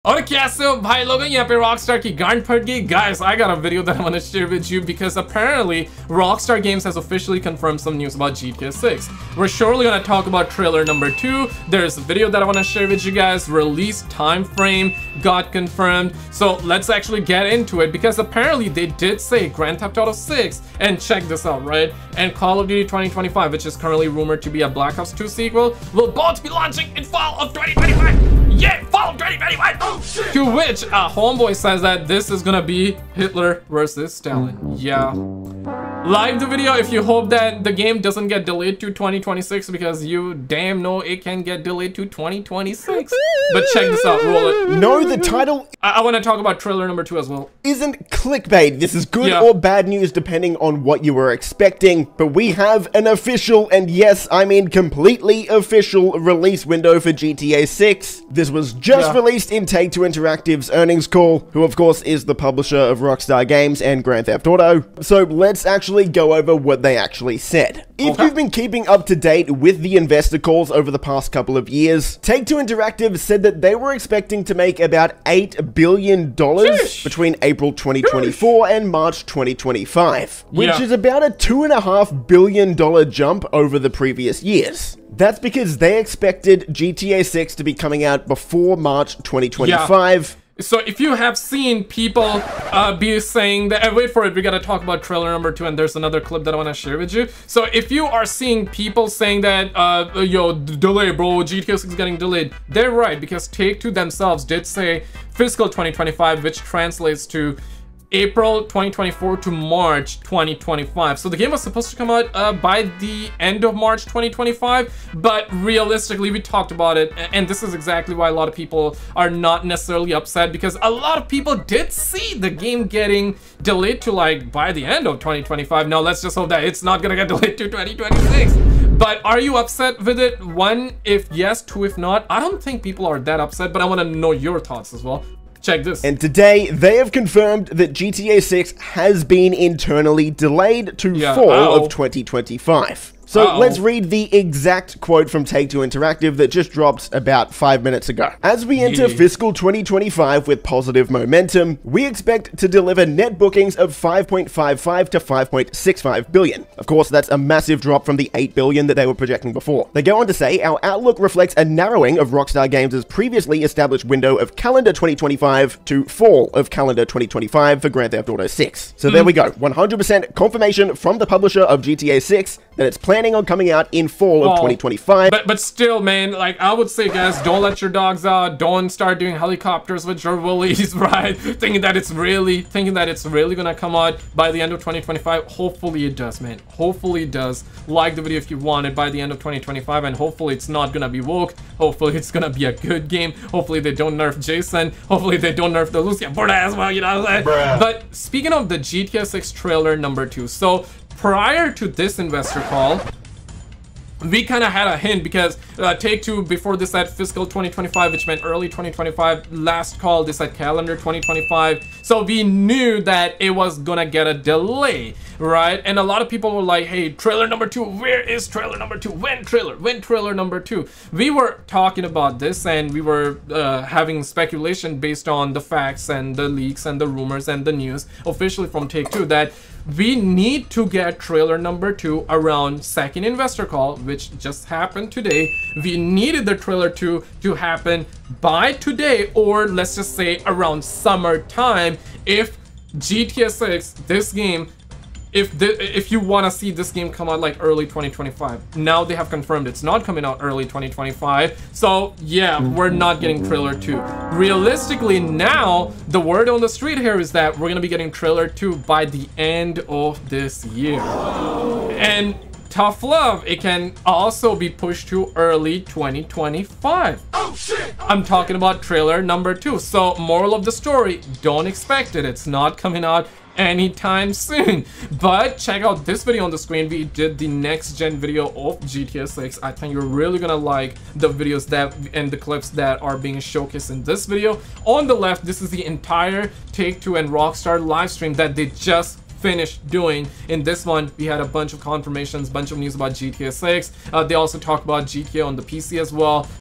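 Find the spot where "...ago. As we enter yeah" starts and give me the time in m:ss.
2:28.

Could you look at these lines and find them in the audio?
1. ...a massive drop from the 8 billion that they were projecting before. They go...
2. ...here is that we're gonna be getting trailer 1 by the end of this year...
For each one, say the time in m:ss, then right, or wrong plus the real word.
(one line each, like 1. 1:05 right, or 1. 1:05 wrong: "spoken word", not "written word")
1. 2:37 right
2. 4:16 wrong: "2", not "1".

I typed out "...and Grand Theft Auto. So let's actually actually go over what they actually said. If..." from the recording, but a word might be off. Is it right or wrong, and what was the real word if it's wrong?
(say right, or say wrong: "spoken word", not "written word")
right.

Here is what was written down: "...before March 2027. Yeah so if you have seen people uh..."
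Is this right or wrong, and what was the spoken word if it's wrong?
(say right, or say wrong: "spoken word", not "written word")
wrong: "2025", not "2027".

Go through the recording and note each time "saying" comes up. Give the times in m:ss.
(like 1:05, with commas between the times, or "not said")
1:33, 1:39, 3:17.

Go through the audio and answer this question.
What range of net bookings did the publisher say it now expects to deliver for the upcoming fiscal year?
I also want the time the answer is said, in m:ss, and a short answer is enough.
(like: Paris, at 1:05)
5.55 to 5.65 billion, at 2:33.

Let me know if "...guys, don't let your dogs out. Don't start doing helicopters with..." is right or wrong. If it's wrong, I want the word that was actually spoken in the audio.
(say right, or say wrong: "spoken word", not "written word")
right.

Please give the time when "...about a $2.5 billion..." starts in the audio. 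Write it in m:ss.
1:20.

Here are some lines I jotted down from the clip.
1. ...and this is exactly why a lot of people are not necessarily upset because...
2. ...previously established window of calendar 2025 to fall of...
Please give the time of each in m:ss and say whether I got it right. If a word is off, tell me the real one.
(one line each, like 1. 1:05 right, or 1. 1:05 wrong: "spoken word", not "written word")
1. 1:57 right
2. 2:43 right.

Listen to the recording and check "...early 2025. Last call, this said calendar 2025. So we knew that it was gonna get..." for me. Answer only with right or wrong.
right.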